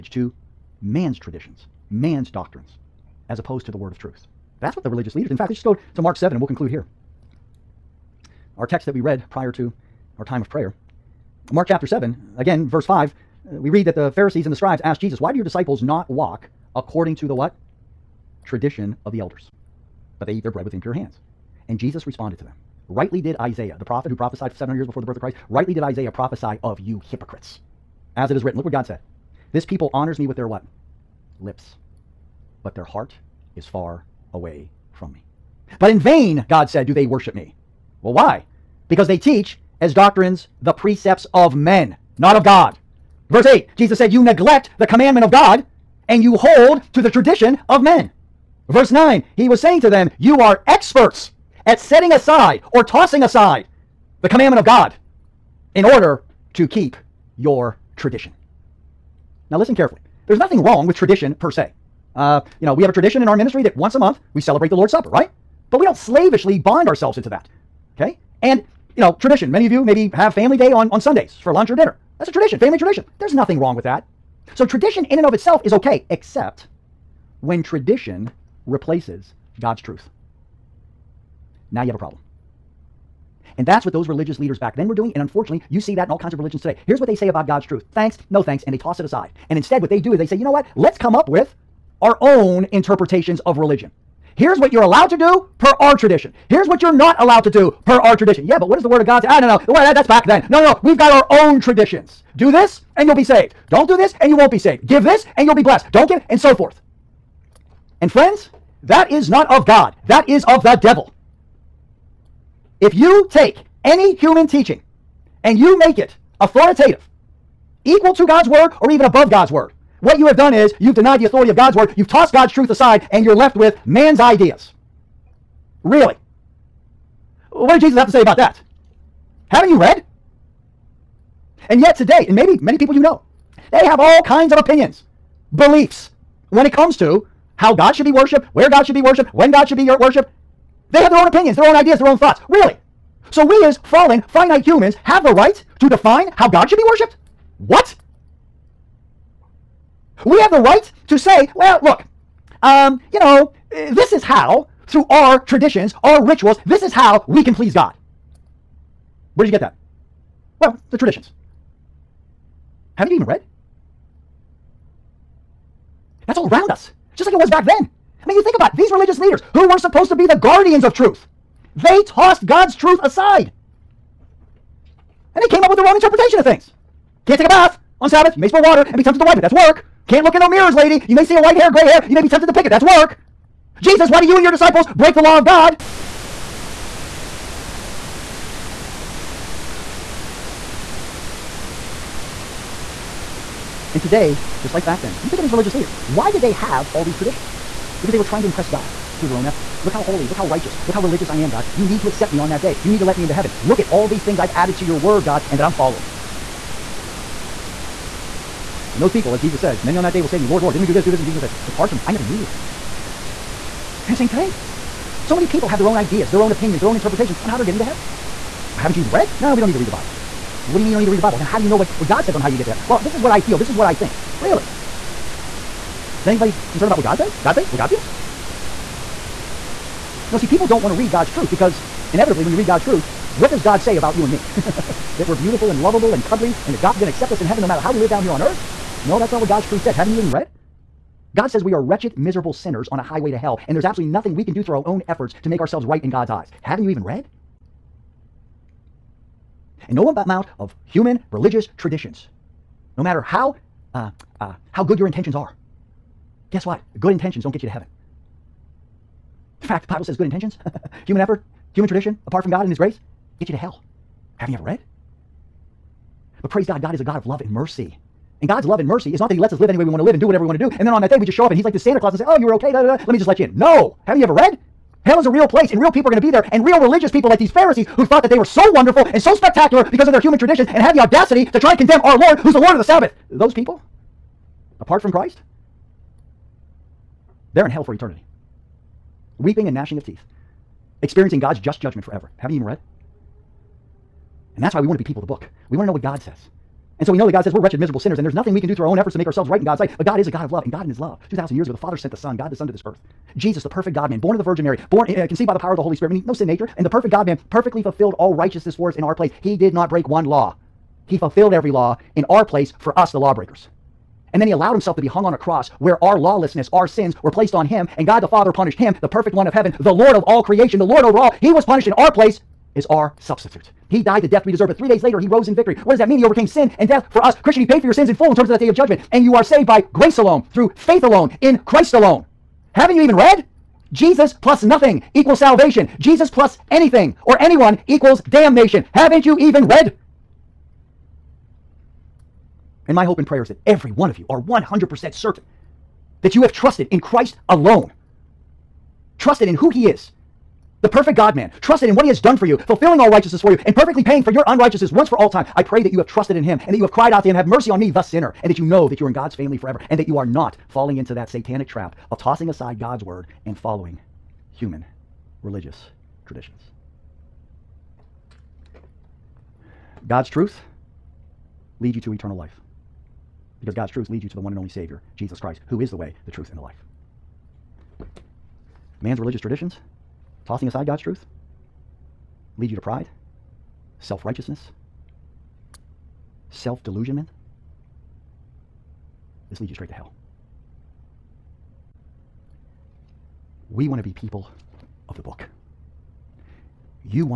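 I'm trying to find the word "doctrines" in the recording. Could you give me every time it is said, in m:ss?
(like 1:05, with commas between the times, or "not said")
0:02, 0:39.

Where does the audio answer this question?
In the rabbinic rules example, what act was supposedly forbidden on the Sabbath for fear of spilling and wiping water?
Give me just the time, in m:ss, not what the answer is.
2:57.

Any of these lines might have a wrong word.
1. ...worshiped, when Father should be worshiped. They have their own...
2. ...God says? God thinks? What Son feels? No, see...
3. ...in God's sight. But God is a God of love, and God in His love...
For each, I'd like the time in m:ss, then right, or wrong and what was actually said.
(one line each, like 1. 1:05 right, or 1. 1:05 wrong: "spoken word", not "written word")
1. 2:19 wrong: "God", not "Father"
2. 3:47 wrong: "God", not "Son"
3. 4:59 right.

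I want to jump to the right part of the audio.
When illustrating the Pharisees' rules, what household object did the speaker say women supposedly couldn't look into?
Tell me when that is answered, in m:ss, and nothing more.
3:00.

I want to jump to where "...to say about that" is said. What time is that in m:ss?
2:08.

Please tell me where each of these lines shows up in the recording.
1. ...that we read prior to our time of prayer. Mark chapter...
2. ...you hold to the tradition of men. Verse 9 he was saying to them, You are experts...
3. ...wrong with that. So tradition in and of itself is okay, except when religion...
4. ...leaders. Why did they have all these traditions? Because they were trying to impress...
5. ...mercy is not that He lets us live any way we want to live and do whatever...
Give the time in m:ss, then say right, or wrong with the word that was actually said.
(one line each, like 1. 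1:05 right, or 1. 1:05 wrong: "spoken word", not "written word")
1. 0:08 right
2. 0:46 right
3. 1:13 wrong: "tradition", not "religion"
4. 3:15 right
5. 4:28 right.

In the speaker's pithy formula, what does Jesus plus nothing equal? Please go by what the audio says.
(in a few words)
Salvation.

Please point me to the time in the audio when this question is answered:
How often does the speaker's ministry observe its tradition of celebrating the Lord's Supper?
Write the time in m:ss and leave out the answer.
1:03.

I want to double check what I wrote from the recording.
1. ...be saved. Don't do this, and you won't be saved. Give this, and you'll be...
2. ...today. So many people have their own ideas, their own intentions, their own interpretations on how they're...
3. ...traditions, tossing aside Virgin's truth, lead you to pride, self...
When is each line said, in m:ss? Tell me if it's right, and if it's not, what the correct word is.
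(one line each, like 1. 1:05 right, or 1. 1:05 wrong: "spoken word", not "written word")
1. 1:43 right
2. 3:34 wrong: "opinions", not "intentions"
3. 6:19 wrong: "God", not "Virgin".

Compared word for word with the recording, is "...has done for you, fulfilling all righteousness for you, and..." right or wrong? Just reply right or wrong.
right.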